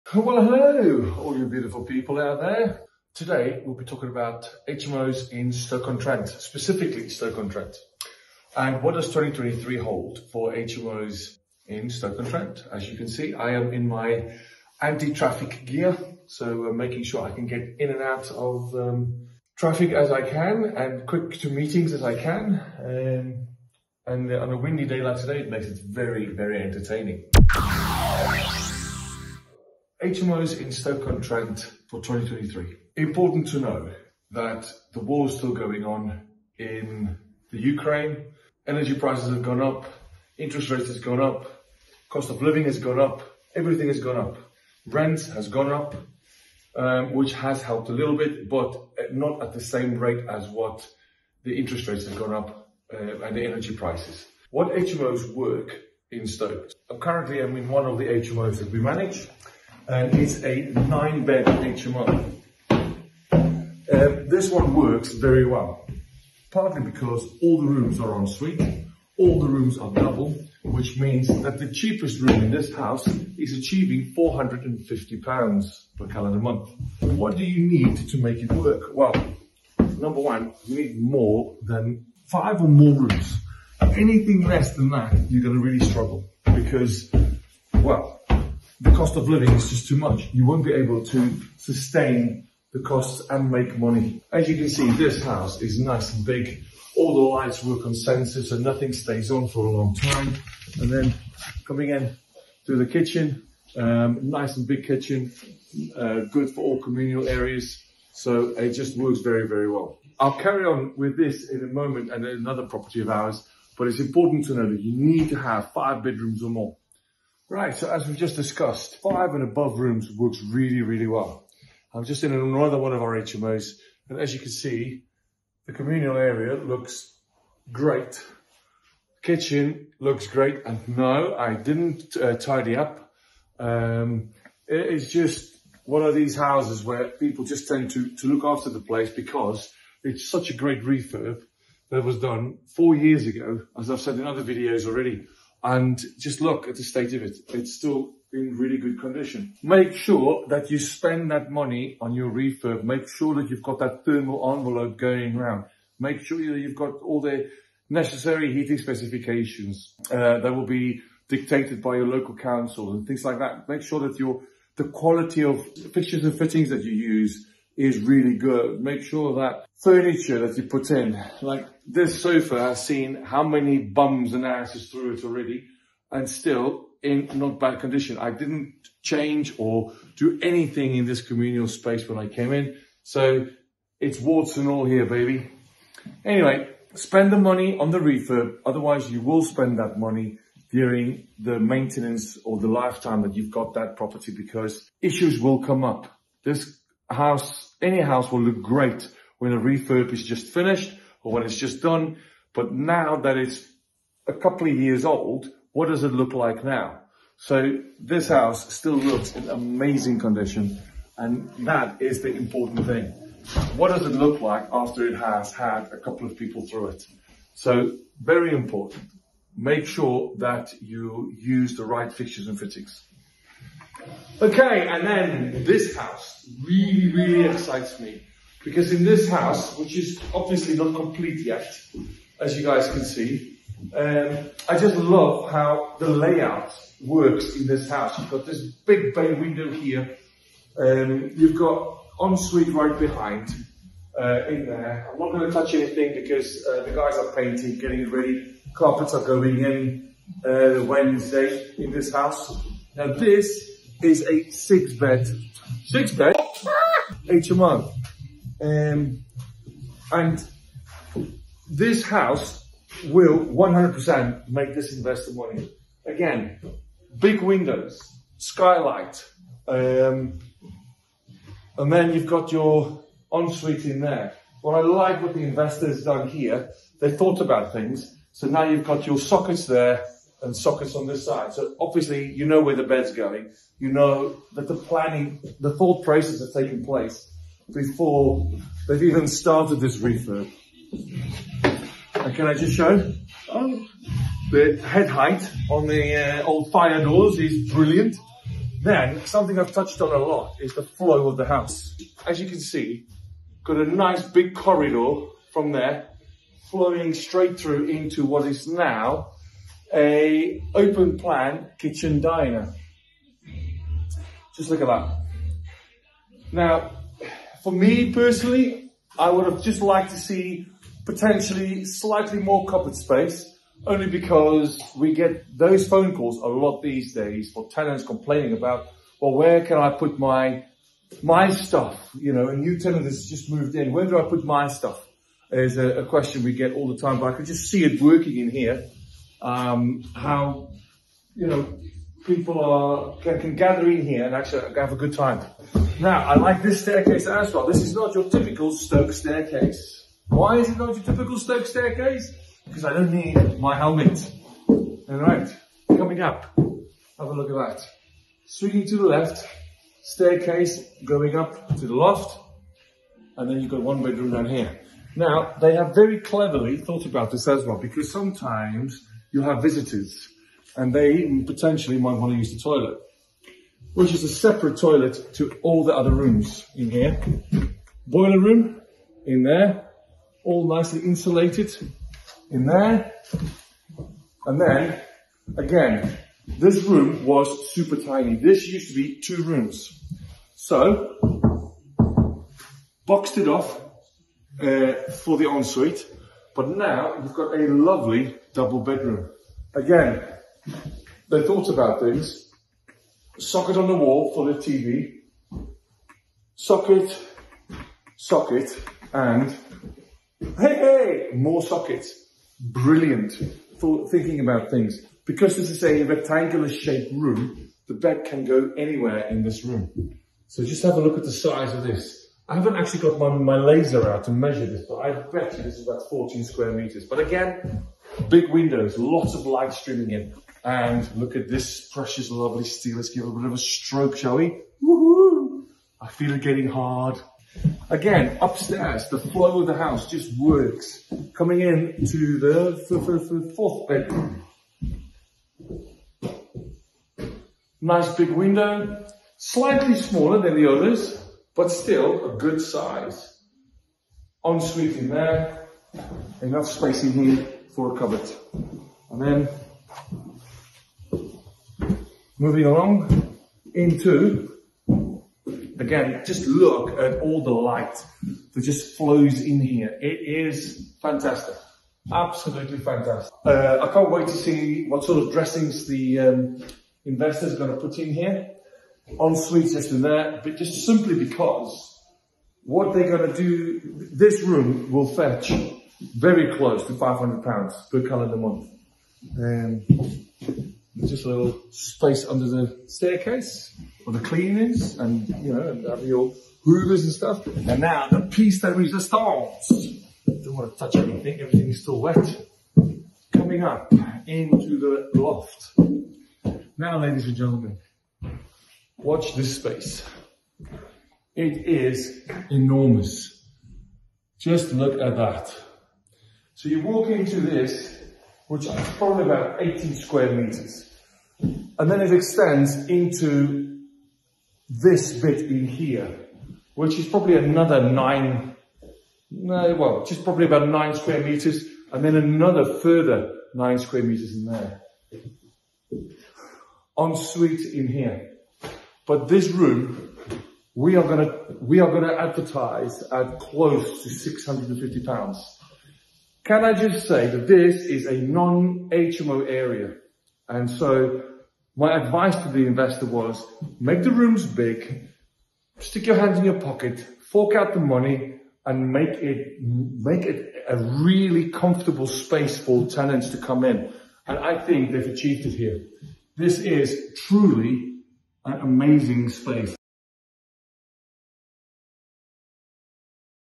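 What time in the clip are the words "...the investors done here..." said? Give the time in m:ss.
4:35.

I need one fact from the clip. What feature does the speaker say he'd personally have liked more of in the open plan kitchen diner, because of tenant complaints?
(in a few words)
Cupboard space.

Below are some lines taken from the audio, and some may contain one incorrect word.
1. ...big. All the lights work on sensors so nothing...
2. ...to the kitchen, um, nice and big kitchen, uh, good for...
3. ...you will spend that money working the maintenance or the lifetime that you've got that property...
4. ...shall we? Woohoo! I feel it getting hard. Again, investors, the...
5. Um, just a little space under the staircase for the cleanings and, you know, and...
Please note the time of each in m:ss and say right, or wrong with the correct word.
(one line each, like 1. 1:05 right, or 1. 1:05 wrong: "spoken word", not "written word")
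1. 1:36 right
2. 1:42 right
3. 3:09 wrong: "during", not "working"
4. 7:14 wrong: "upstairs", not "investors"
5. 8:09 right.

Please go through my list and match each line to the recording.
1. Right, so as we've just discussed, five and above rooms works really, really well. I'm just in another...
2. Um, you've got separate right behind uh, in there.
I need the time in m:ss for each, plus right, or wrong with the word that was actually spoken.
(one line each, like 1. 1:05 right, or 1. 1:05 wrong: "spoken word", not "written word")
1. 1:57 right
2. 4:00 wrong: "ensuite", not "separate".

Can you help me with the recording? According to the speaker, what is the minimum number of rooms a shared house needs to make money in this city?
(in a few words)
5.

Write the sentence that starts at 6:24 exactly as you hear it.
And then again, this room was super tiny.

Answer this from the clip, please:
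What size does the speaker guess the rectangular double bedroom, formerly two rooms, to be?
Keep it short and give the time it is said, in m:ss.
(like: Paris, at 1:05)
14 square meters, at 7:06.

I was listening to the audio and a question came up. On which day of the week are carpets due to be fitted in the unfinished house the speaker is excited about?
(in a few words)
Wednesday.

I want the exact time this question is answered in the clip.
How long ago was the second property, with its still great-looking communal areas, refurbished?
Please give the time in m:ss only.
2:22.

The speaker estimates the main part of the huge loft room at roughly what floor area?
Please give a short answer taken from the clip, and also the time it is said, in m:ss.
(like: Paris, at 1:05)
18 square meters, at 8:39.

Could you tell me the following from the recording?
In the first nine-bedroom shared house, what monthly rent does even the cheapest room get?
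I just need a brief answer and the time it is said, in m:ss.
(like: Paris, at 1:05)
£450, at 1:14.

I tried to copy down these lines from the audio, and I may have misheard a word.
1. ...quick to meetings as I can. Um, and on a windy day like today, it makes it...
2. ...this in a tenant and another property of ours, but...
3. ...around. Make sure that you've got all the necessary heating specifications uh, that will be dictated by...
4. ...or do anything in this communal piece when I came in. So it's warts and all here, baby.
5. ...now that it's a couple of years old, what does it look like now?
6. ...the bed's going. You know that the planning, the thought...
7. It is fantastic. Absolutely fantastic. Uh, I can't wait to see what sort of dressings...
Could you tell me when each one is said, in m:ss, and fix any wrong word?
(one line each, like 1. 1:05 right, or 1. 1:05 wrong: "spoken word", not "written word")
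1. 0:21 right
2. 1:51 wrong: "moment", not "tenant"
3. 2:35 right
4. 2:59 wrong: "space", not "piece"
5. 3:22 right
6. 4:42 right
7. 7:50 right.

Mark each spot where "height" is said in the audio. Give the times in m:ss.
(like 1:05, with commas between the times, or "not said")
4:55.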